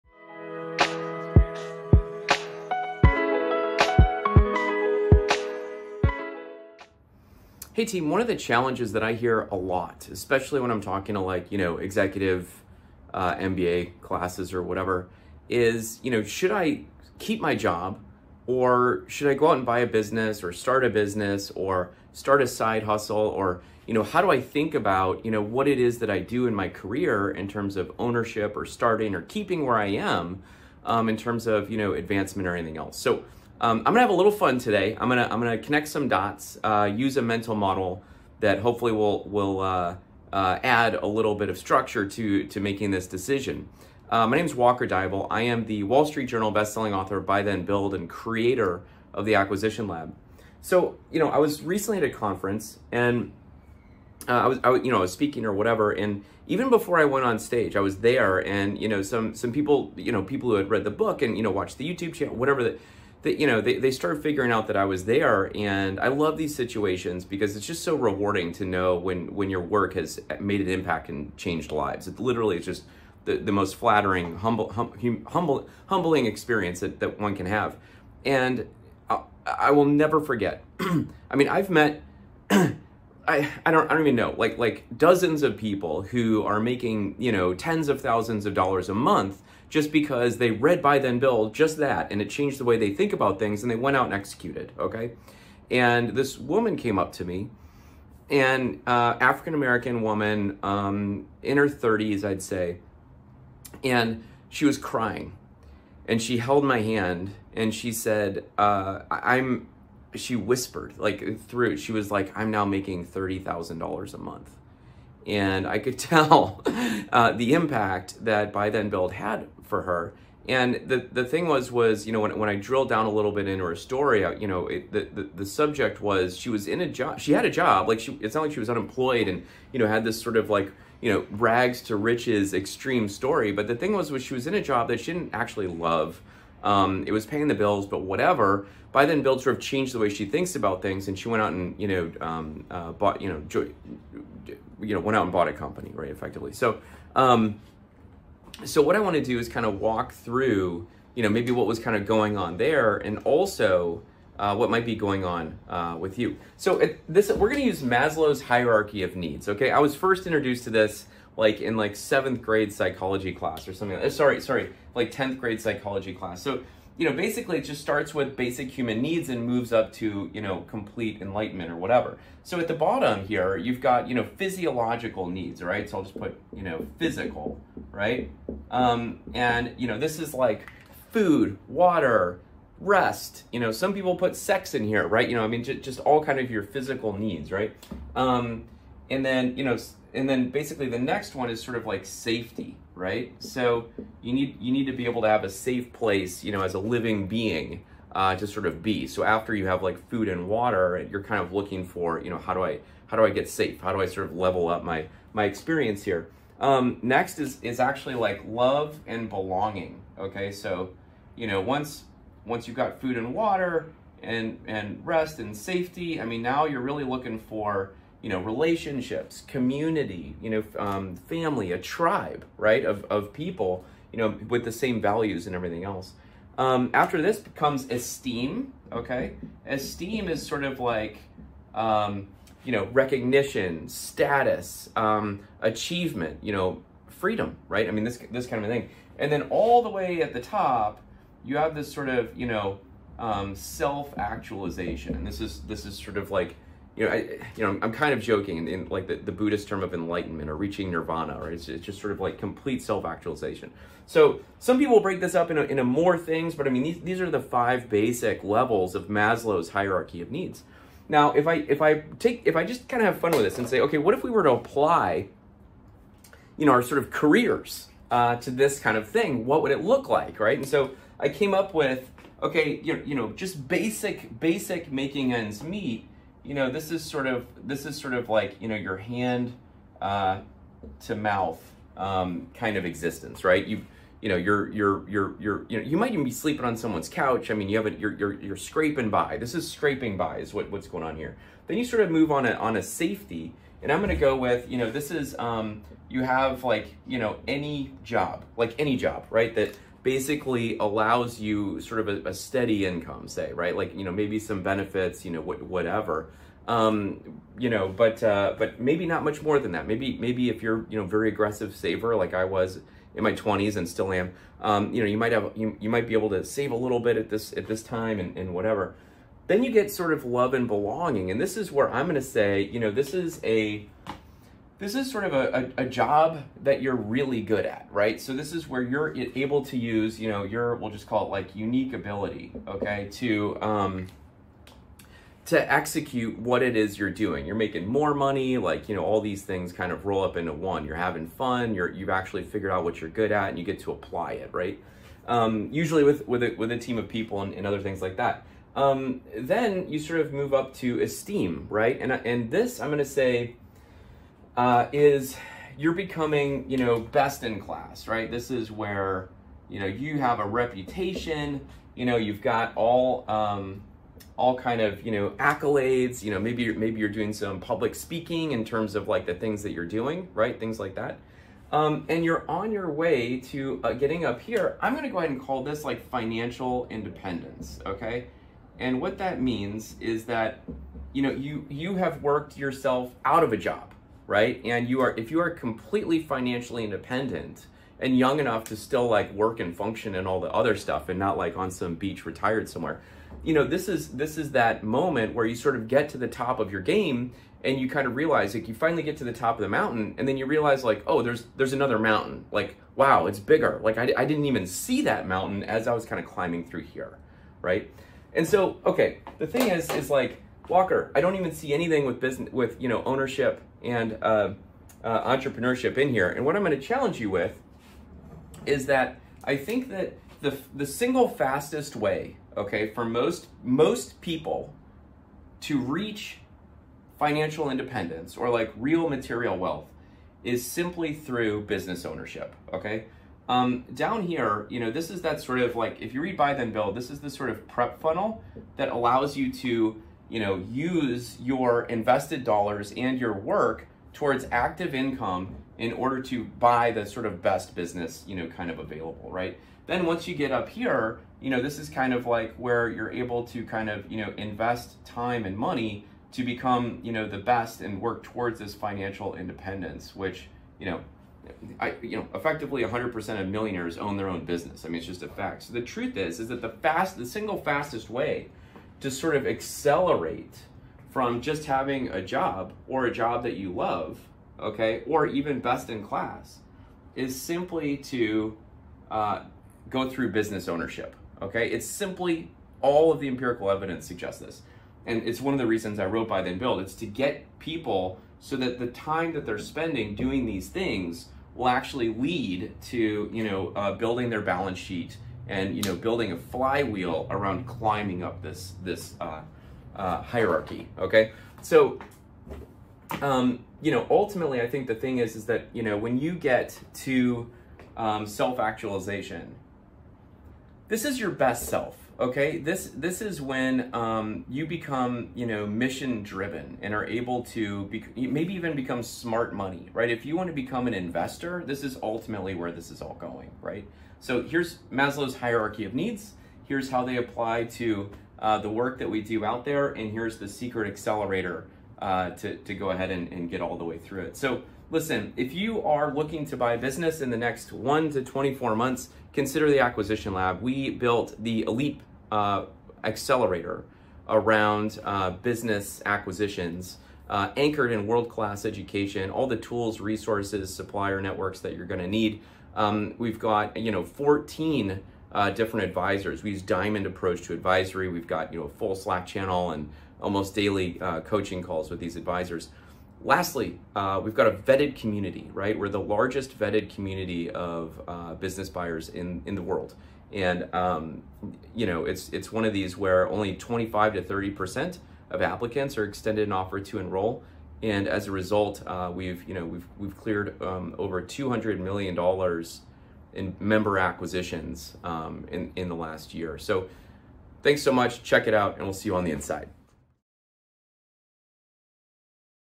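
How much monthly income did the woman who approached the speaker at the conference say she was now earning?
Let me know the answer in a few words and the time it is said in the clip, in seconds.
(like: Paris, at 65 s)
$30000 a month, at 113 s.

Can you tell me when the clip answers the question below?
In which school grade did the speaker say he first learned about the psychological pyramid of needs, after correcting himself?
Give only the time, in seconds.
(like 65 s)
165 s.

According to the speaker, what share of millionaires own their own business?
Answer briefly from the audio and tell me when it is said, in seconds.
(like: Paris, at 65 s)
100%, at 462 s.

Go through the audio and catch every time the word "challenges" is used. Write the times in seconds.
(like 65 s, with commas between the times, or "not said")
8 s, 416 s.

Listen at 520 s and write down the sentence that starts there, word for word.
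If you want to become an investor, this is ultimately where this is all going, right?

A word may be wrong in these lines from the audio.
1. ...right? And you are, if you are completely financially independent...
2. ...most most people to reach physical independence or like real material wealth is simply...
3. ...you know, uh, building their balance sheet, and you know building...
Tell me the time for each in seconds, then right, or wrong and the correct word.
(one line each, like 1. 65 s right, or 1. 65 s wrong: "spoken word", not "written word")
1. 384 s right
2. 423 s wrong: "financial", not "physical"
3. 493 s right.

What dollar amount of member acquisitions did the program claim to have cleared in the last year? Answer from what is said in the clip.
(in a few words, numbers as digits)
over $200 million.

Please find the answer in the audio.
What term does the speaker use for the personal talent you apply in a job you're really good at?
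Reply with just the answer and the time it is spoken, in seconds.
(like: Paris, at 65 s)
unique ability, at 331 s.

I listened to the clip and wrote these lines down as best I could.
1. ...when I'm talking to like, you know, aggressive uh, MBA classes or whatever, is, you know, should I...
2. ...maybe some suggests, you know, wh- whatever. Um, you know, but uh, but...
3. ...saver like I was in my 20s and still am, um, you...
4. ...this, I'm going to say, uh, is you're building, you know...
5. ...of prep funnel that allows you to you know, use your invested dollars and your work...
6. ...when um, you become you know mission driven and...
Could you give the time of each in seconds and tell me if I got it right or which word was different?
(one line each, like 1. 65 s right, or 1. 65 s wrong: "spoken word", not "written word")
1. 10 s wrong: "executive", not "aggressive"
2. 304 s wrong: "benefits", not "suggests"
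3. 311 s right
4. 352 s wrong: "becoming", not "building"
5. 437 s right
6. 513 s right.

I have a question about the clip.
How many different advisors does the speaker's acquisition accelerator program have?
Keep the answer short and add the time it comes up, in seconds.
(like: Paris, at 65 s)
14, at 554 s.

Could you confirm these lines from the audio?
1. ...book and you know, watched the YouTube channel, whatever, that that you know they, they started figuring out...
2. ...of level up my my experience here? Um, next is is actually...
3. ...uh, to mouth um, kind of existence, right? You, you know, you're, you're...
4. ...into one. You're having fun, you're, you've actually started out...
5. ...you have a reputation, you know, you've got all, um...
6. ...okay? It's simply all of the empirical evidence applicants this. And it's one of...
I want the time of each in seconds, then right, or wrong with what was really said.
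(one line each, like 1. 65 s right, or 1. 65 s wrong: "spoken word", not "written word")
1. 60 s right
2. 204 s right
3. 280 s right
4. 340 s wrong: "figured", not "started"
5. 359 s right
6. 481 s wrong: "suggests", not "applicants".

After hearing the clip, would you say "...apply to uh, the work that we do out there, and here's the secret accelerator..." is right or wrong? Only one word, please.
right.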